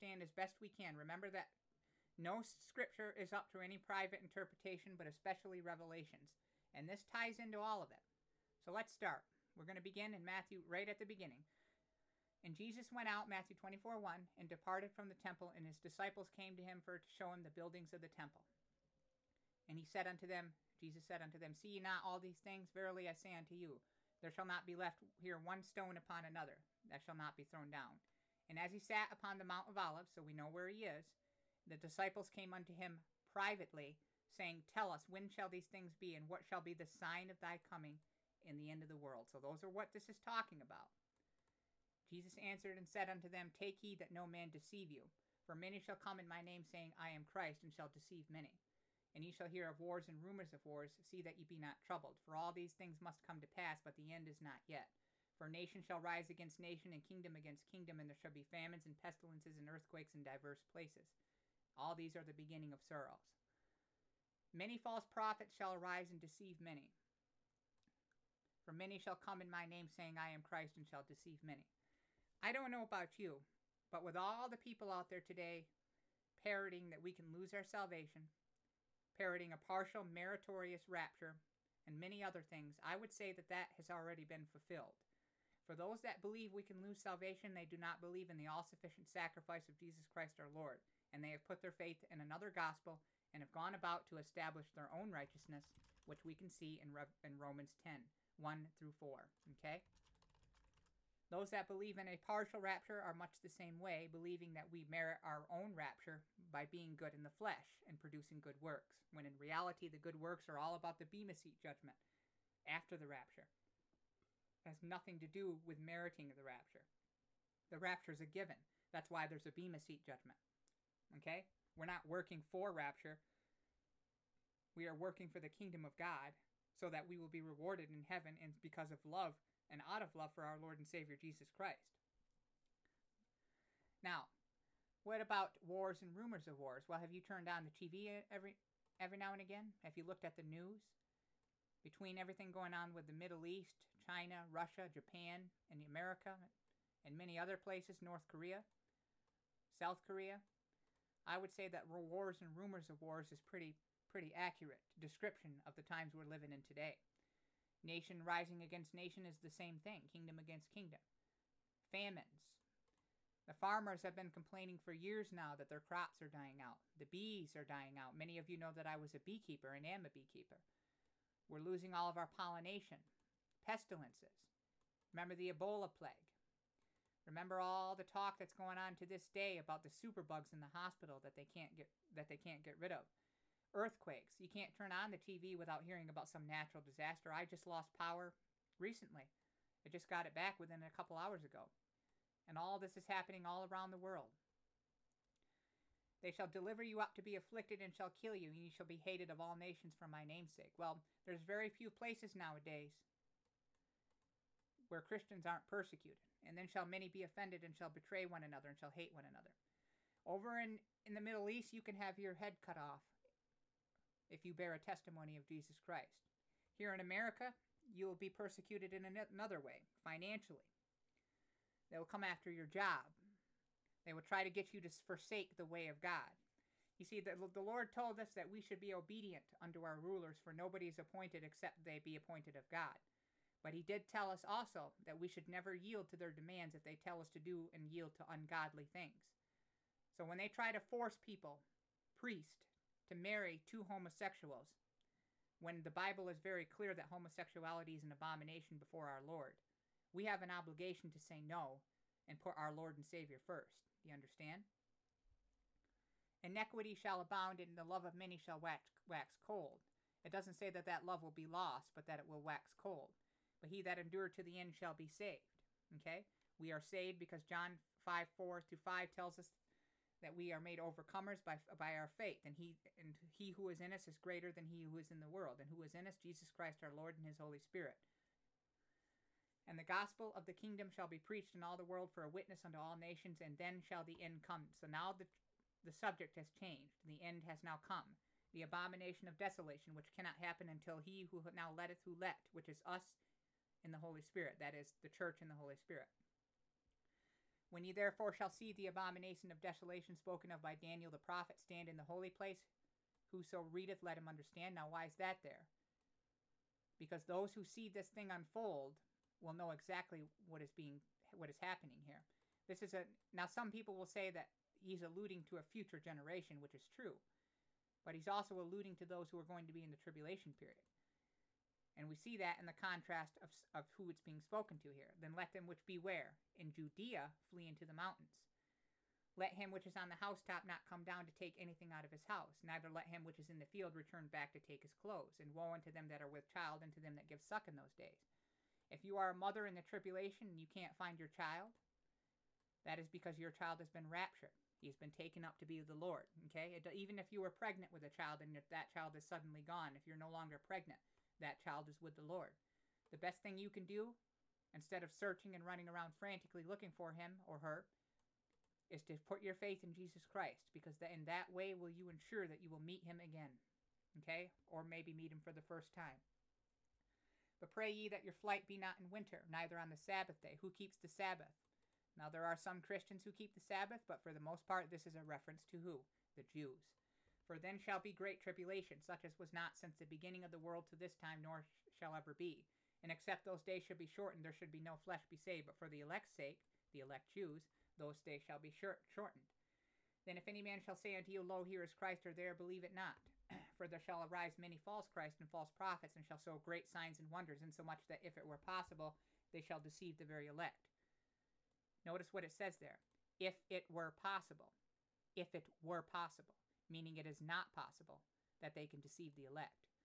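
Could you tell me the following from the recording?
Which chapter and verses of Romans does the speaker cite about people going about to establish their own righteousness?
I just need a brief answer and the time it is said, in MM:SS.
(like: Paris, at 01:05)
Romans 10:1-4, at 01:37.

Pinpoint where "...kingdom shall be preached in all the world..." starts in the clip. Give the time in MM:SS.
04:40.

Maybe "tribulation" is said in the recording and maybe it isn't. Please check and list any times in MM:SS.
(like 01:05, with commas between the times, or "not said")
05:19, 05:39, 06:18.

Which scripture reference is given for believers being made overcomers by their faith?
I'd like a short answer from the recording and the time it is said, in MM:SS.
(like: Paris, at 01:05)
John 5:4-5, at 04:27.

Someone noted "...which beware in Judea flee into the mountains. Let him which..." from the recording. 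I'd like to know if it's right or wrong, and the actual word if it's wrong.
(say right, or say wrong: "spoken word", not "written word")
right.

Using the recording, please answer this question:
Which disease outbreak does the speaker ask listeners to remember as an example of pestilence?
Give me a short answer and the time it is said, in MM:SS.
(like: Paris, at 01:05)
Ebola, at 02:55.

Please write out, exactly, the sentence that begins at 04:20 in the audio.
It doesn't say that that love will be lost, but that it will wax cold.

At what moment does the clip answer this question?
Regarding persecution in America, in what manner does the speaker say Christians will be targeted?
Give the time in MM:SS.
03:39.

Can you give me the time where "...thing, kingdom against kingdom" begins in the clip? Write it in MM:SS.
02:39.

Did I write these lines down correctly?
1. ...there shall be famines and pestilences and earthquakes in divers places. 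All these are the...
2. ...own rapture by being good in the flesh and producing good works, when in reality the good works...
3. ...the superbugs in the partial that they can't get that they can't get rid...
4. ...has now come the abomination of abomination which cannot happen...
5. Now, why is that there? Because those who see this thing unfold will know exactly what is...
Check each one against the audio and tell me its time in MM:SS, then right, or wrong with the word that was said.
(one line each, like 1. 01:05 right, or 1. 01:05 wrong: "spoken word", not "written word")
1. 00:58 right
2. 01:45 right
3. 02:59 wrong: "hospital", not "partial"
4. 04:47 wrong: "desolation", not "abomination"
5. 05:04 right.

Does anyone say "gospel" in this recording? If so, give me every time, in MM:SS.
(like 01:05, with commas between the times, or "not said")
01:32, 04:39.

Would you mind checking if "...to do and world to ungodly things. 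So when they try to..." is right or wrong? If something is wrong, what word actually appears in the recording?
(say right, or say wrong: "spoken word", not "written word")
wrong: "yield", not "world".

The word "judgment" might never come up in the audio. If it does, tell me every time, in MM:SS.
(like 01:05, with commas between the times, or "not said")
01:51, 02:00.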